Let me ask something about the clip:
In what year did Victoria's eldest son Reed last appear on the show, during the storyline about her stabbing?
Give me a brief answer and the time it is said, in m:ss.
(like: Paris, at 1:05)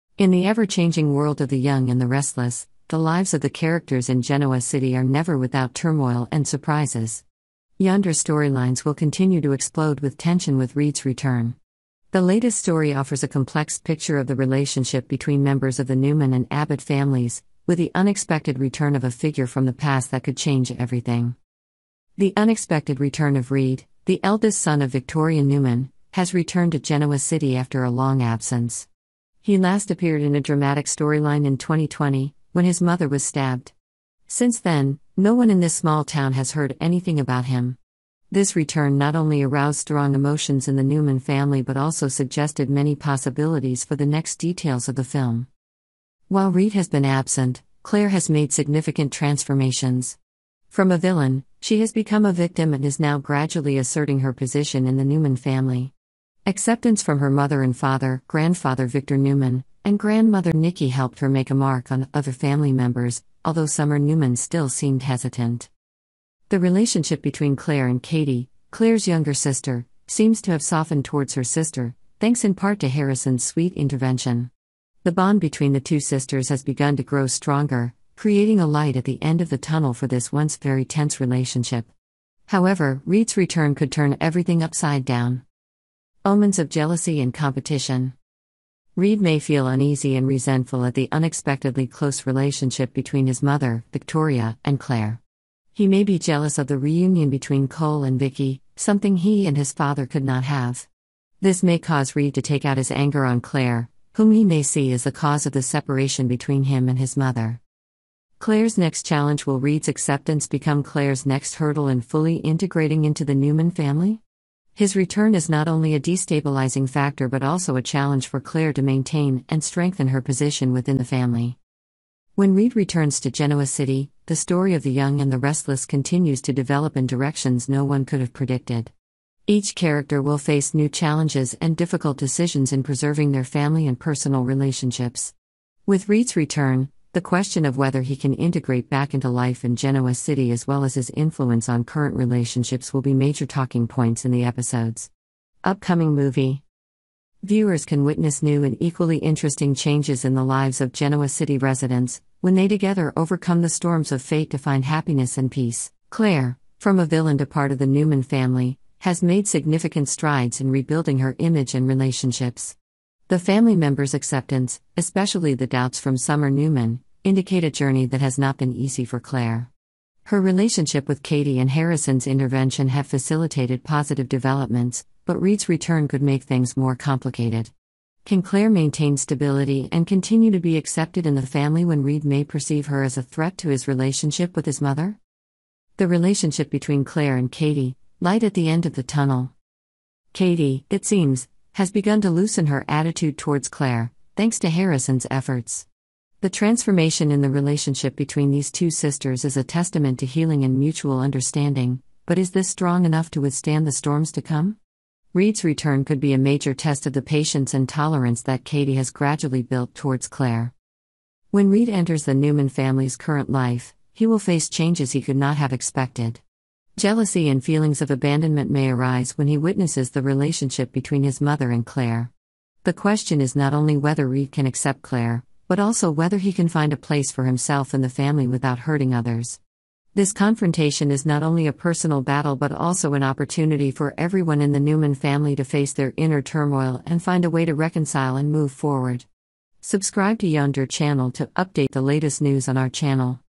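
2020, at 0:31.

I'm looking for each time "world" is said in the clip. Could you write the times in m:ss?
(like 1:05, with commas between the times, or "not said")
0:01.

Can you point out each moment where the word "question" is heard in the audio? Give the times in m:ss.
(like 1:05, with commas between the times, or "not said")
2:17, 3:42.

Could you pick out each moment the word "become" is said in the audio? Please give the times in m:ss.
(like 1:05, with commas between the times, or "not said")
0:51, 1:50.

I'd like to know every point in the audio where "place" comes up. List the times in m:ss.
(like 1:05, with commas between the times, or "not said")
3:46.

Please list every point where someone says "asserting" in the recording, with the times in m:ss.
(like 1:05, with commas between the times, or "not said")
0:53.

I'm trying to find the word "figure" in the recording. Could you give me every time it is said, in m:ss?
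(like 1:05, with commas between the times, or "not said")
0:19.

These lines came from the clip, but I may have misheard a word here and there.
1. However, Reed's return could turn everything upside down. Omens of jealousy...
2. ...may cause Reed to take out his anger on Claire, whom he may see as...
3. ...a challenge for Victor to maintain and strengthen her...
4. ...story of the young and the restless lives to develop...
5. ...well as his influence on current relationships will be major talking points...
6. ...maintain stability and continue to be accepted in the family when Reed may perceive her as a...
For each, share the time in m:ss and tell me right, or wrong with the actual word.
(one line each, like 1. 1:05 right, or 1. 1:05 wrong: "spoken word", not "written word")
1. 1:22 right
2. 1:41 right
3. 1:57 wrong: "Claire", not "Victor"
4. 2:04 wrong: "continues", not "lives"
5. 2:20 right
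6. 2:58 right.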